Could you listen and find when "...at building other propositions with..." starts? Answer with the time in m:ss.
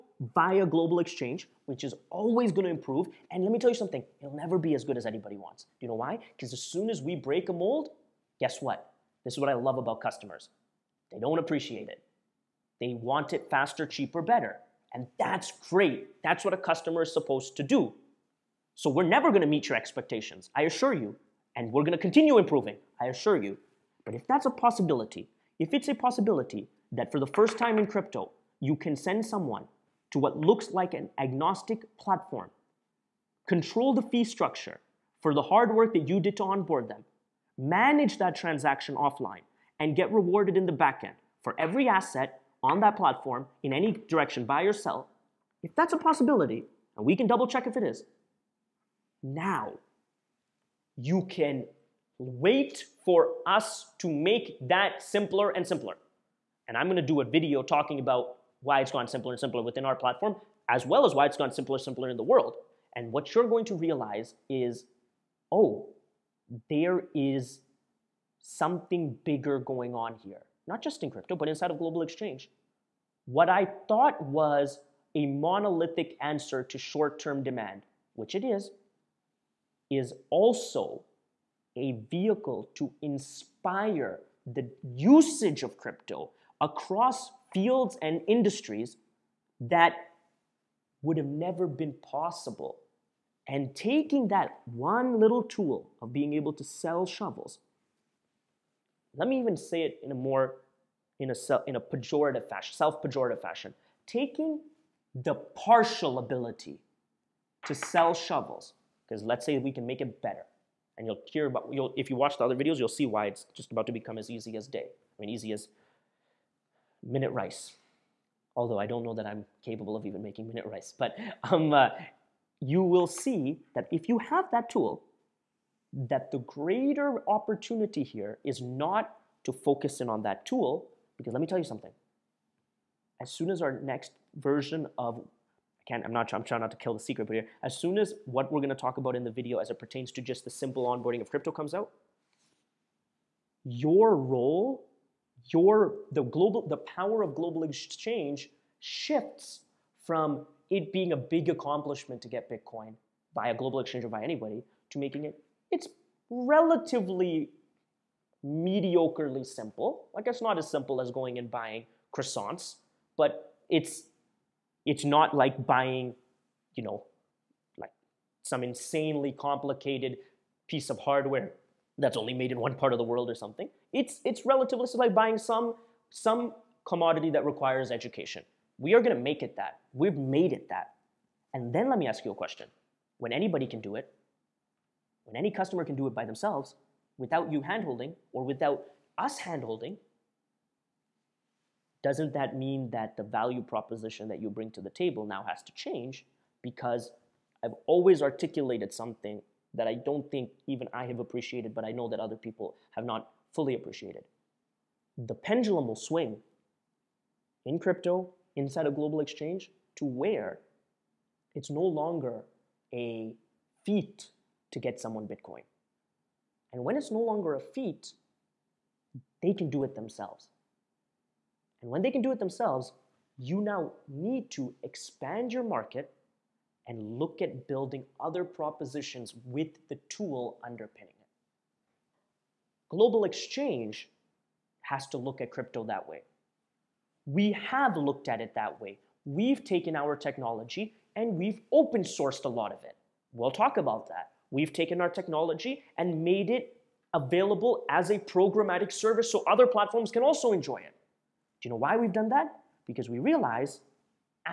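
3:47.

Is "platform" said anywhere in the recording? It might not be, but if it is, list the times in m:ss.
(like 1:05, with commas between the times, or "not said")
0:31, 0:42, 0:59, 4:09.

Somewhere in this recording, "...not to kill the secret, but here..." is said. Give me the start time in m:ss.
2:16.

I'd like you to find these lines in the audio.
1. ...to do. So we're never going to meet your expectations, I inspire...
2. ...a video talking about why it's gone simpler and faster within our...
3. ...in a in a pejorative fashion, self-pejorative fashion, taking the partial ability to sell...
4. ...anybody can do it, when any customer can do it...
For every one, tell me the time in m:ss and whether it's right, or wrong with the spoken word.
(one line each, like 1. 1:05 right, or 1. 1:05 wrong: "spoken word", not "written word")
1. 0:17 wrong: "assure", not "inspire"
2. 0:57 wrong: "simpler", not "faster"
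3. 1:41 right
4. 3:03 right.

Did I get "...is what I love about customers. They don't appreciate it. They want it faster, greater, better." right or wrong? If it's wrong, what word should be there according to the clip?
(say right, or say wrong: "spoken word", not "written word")
wrong: "cheaper", not "greater".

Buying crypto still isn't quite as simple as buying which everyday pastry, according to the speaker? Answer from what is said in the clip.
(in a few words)
Croissants.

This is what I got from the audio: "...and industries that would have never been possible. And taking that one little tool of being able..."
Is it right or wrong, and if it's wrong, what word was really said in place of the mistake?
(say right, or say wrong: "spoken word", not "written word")
right.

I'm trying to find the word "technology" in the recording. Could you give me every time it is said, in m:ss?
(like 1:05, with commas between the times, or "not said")
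4:00, 4:05.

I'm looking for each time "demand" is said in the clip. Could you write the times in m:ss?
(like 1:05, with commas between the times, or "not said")
1:17.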